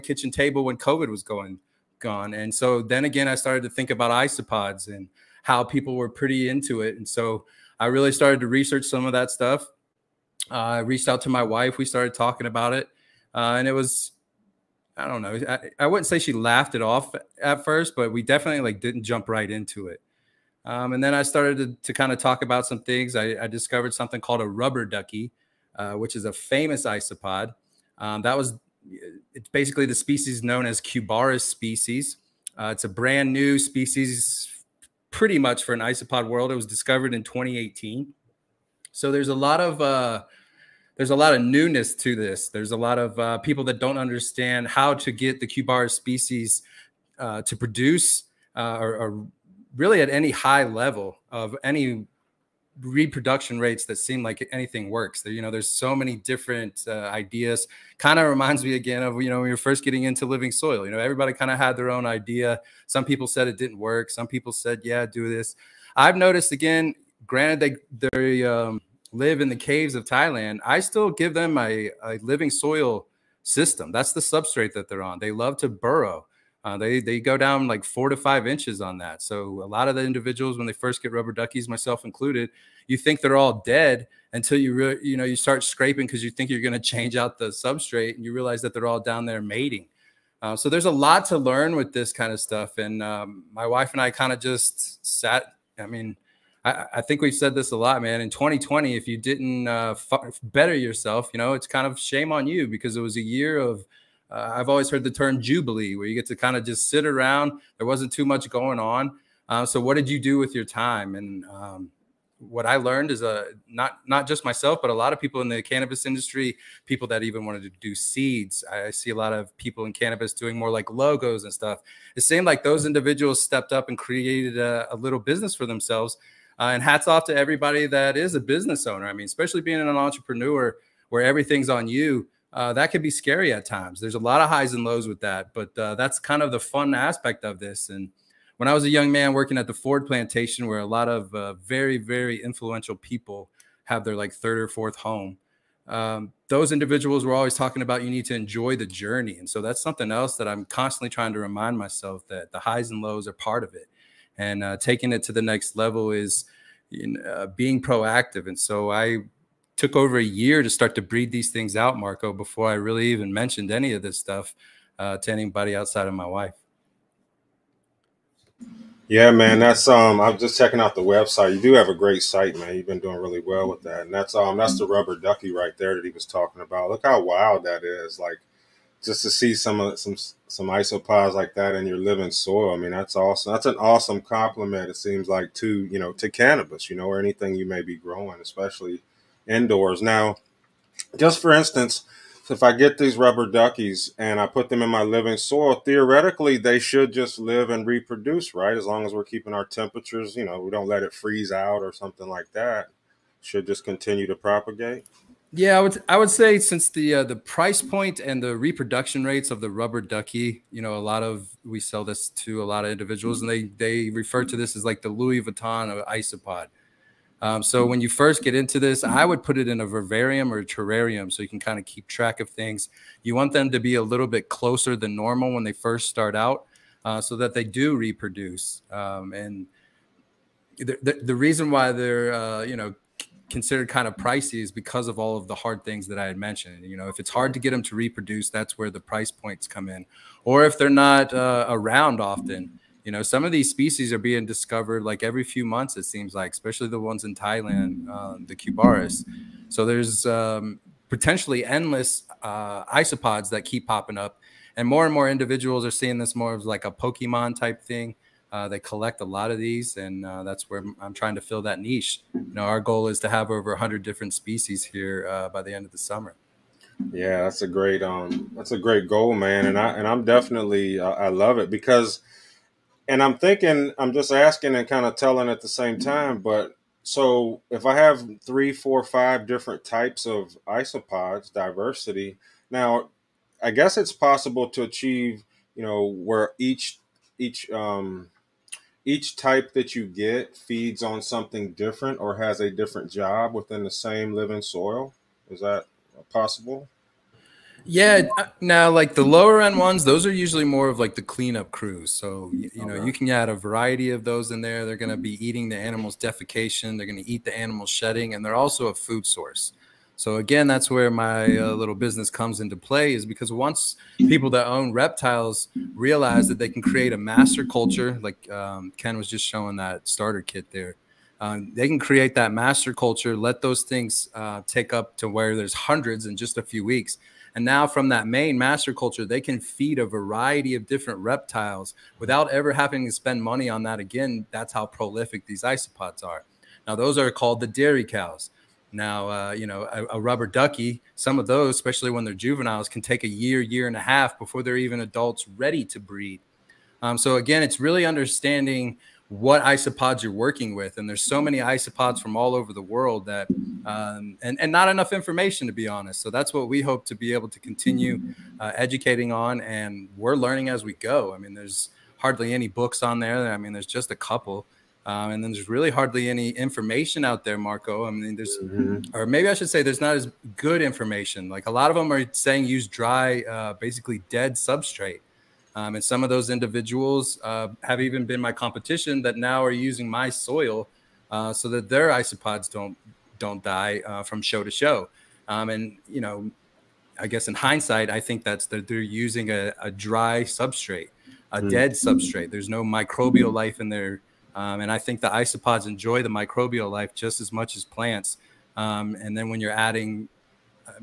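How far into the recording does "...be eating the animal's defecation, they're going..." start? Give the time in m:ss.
5:05.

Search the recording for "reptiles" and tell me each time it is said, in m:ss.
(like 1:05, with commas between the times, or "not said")
5:14, 5:31.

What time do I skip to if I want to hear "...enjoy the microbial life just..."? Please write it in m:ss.
6:35.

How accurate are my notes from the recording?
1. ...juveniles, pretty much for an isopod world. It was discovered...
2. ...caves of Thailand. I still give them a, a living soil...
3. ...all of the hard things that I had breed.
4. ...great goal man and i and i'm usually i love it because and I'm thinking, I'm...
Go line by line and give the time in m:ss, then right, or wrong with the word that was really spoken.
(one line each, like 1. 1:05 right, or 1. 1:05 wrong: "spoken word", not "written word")
1. 0:33 wrong: "species", not "juveniles"
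2. 1:09 right
3. 3:55 wrong: "mentioned", not "breed"
4. 4:28 wrong: "definitely", not "usually".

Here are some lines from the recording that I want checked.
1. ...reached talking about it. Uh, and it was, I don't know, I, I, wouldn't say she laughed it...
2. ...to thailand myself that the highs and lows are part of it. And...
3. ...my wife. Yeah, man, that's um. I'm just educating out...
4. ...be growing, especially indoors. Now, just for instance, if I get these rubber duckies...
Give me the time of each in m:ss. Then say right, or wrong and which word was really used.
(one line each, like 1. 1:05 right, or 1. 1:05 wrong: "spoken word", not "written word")
1. 0:11 wrong: "started", not "reached"
2. 2:31 wrong: "remind", not "thailand"
3. 2:46 wrong: "checking", not "educating"
4. 3:07 right.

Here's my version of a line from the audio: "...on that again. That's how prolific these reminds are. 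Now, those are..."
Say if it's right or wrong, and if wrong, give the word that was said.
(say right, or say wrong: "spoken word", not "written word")
wrong: "isopods", not "reminds".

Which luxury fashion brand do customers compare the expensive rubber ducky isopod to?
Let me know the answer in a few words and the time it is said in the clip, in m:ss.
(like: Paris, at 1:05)
Louis Vuitton, at 3:35.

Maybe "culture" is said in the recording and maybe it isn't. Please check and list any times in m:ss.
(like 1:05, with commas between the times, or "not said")
5:17, 5:22, 5:28.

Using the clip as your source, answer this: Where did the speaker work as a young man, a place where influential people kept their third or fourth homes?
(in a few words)
Ford Plantation.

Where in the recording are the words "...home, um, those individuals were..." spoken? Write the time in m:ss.
2:24.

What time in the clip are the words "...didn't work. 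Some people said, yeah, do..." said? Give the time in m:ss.
1:03.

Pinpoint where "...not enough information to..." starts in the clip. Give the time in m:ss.
5:54.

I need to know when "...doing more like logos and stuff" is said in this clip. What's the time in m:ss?
2:00.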